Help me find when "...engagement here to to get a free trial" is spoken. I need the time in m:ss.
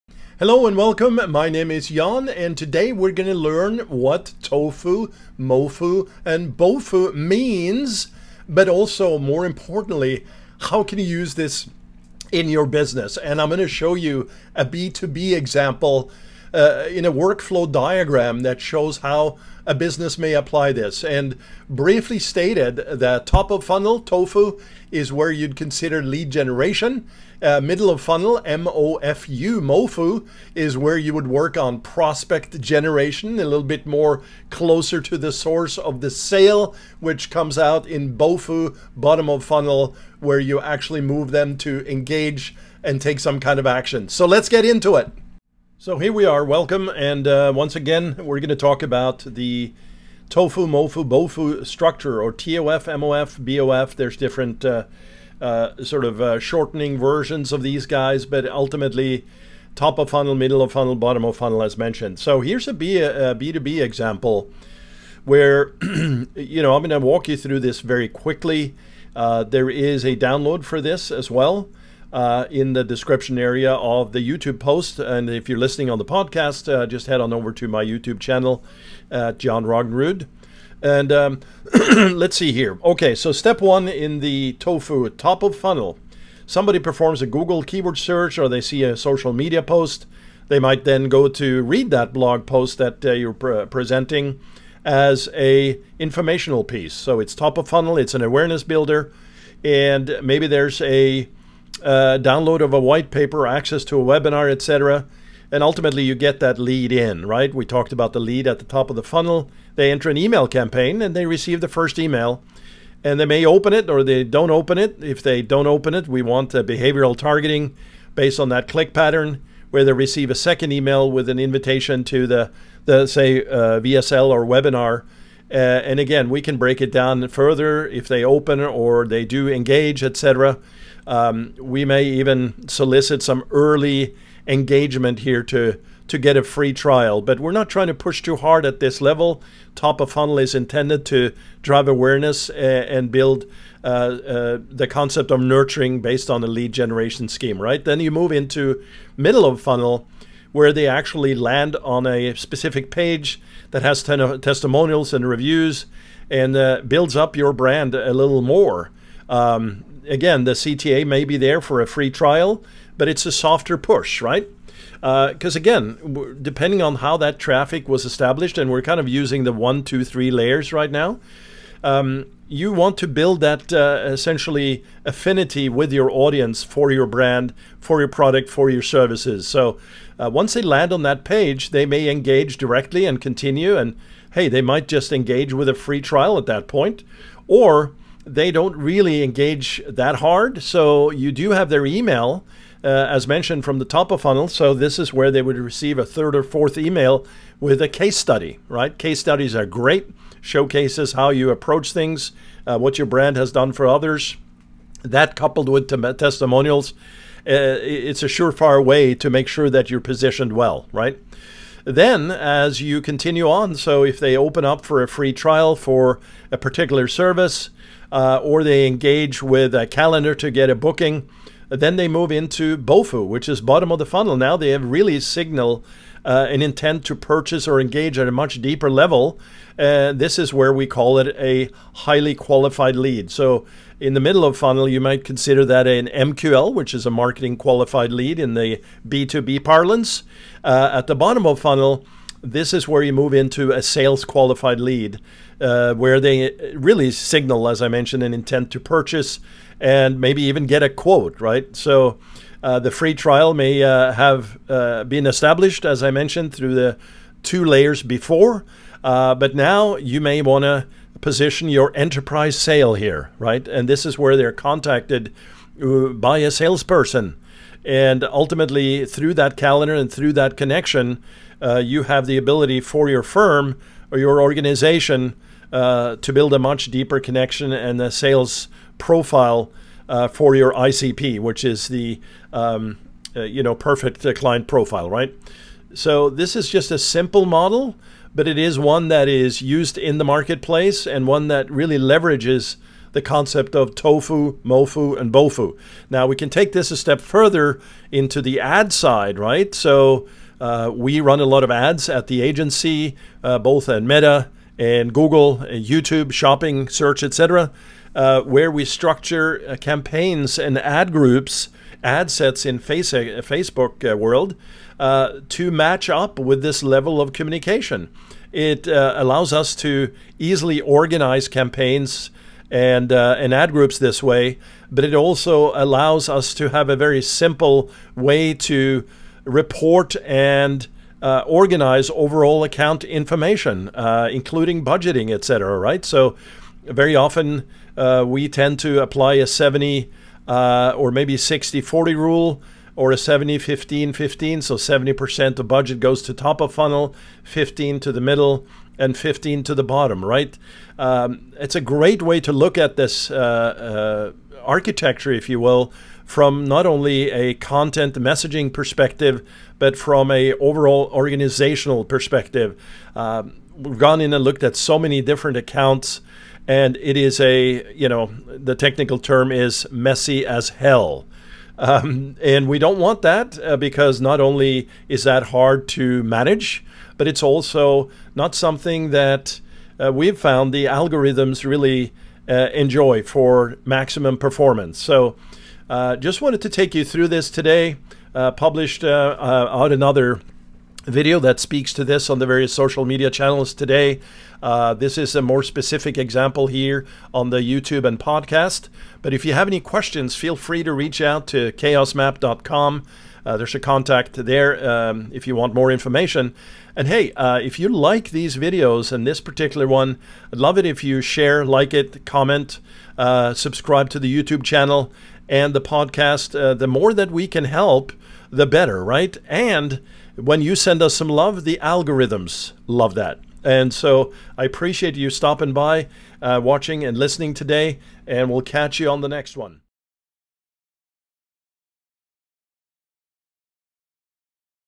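2:14.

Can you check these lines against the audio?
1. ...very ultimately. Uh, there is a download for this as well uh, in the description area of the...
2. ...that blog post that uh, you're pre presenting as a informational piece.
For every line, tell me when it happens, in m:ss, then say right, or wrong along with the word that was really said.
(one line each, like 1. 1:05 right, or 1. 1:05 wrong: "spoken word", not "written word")
1. 1:07 wrong: "quickly", not "ultimately"
2. 1:31 right.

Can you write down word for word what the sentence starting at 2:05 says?
Uh, and again, we can break it down further if they open or they do engage, etc.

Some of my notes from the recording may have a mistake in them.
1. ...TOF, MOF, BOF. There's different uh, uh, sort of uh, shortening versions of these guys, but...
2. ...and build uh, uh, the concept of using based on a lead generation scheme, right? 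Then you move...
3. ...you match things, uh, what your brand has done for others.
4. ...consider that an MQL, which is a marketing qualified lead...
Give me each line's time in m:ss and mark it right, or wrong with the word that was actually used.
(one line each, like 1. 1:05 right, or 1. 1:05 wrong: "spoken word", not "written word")
1. 0:52 right
2. 2:22 wrong: "nurturing", not "using"
3. 3:21 wrong: "approach", not "match"
4. 3:55 right.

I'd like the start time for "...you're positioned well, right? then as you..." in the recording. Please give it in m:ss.
3:29.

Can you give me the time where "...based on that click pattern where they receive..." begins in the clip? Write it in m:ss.
1:58.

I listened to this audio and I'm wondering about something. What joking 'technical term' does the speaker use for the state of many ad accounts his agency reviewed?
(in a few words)
Messy as hell.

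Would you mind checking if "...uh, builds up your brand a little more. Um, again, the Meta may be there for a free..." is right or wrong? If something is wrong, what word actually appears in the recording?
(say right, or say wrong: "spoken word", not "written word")
wrong: "CTA", not "Meta".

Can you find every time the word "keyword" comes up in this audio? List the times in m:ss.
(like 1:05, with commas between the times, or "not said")
1:27.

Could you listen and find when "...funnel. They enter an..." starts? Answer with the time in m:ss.
1:49.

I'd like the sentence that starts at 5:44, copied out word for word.
So 70% of budget goes to top of funnel, 15 to the middle, and 15 to the bottom.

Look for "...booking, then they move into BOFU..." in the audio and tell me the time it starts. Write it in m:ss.
3:40.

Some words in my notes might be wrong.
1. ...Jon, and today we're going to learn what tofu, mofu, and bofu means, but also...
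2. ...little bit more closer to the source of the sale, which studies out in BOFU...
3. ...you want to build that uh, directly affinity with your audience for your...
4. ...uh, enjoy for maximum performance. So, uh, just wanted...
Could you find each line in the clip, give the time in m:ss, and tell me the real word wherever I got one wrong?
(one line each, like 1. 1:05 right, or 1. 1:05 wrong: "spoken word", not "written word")
1. 0:01 right
2. 0:33 wrong: "comes", not "studies"
3. 2:52 wrong: "essentially", not "directly"
4. 6:22 right.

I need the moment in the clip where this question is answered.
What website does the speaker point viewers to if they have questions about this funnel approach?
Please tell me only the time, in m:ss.
6:41.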